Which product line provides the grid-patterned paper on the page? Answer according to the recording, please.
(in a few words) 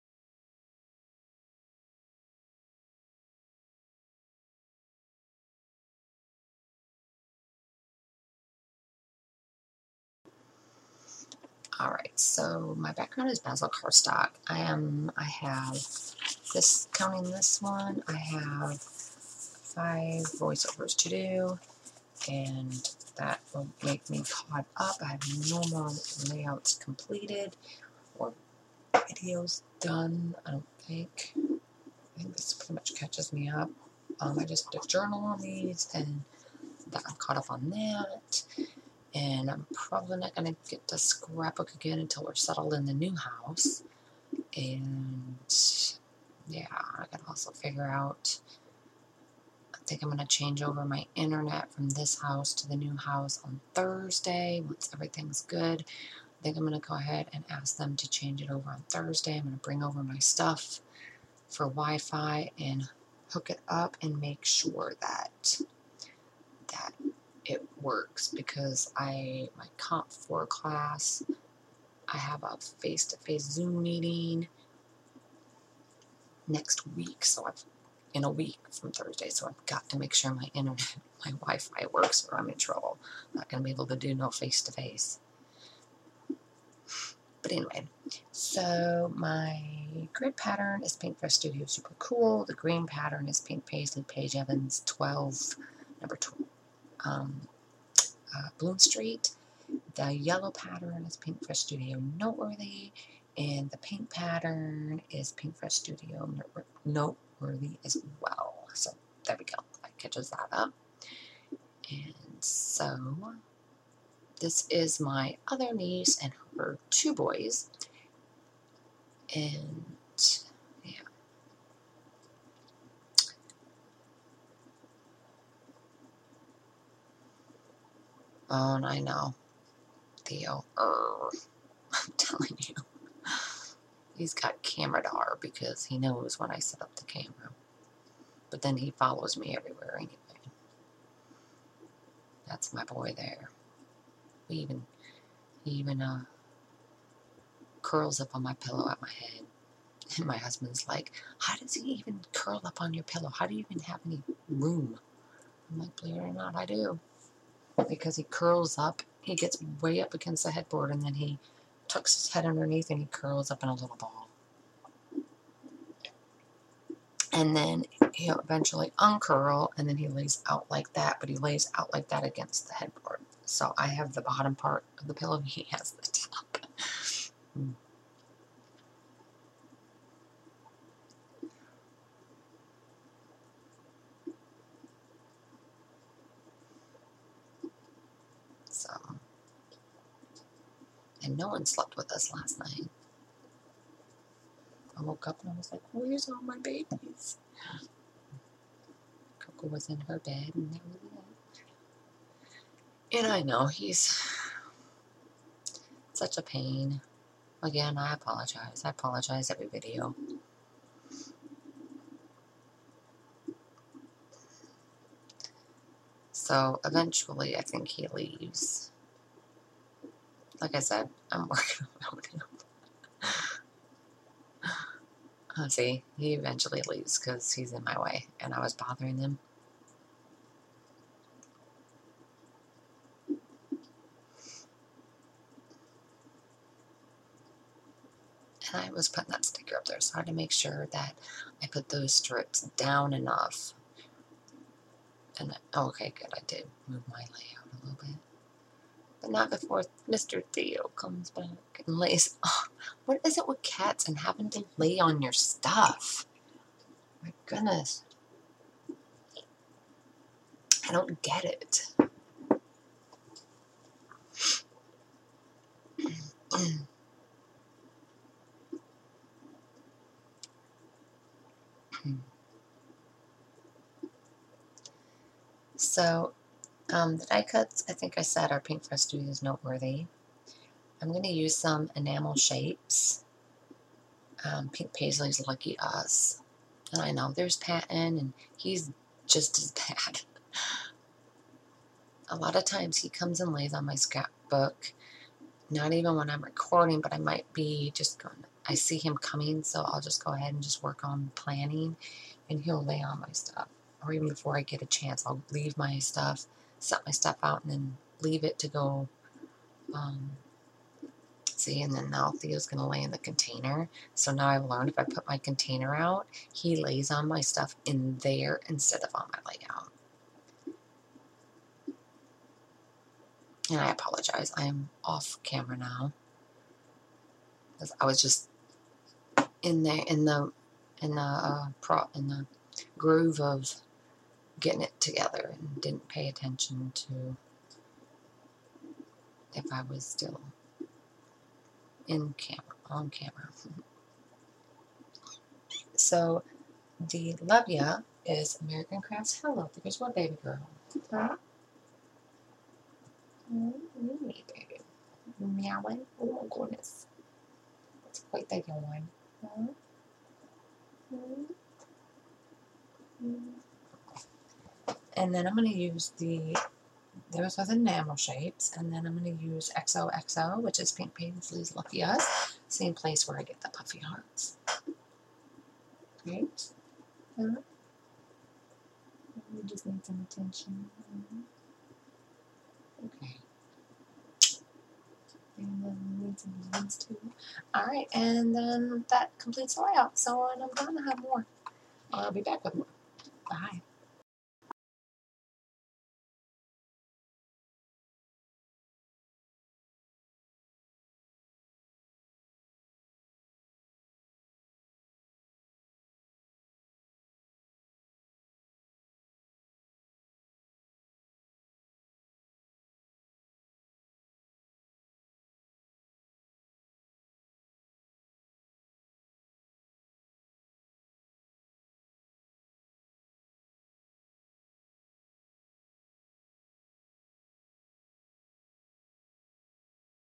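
Paintbrush Studio Super Cool.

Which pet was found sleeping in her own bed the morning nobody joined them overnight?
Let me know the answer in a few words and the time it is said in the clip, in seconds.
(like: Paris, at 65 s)
Coco, at 199 s.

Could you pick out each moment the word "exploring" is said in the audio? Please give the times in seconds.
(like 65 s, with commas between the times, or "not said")
not said.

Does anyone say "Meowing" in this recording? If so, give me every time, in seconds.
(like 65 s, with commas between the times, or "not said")
355 s.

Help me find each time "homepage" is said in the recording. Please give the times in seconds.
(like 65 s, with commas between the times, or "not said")
not said.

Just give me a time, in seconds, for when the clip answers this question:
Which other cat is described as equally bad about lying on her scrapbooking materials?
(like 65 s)
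287 s.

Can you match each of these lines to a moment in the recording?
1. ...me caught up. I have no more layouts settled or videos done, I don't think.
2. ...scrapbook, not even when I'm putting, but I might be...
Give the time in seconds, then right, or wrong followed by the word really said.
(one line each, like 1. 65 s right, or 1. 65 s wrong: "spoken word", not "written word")
1. 24 s wrong: "completed", not "settled"
2. 293 s wrong: "recording", not "putting".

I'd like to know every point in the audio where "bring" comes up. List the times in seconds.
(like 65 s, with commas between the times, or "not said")
59 s.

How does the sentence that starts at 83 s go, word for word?
I'm not going to be able to do no face-to-face.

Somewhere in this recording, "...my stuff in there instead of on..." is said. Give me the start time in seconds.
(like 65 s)
317 s.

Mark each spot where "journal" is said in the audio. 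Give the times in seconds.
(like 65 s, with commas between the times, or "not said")
34 s.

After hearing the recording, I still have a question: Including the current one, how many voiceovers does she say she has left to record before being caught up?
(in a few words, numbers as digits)
5.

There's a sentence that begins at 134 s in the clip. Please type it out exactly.
He's got camera dar because he knows when I set up the camera.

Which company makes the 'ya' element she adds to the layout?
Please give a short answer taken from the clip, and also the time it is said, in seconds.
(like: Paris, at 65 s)
American Crafts, at 348 s.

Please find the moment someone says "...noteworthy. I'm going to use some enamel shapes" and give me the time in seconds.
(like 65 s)
279 s.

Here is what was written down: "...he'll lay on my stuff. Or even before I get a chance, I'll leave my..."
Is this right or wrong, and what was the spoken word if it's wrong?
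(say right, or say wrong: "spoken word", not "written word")
right.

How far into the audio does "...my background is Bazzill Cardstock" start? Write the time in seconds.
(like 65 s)
12 s.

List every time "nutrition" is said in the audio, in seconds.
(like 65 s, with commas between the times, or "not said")
not said.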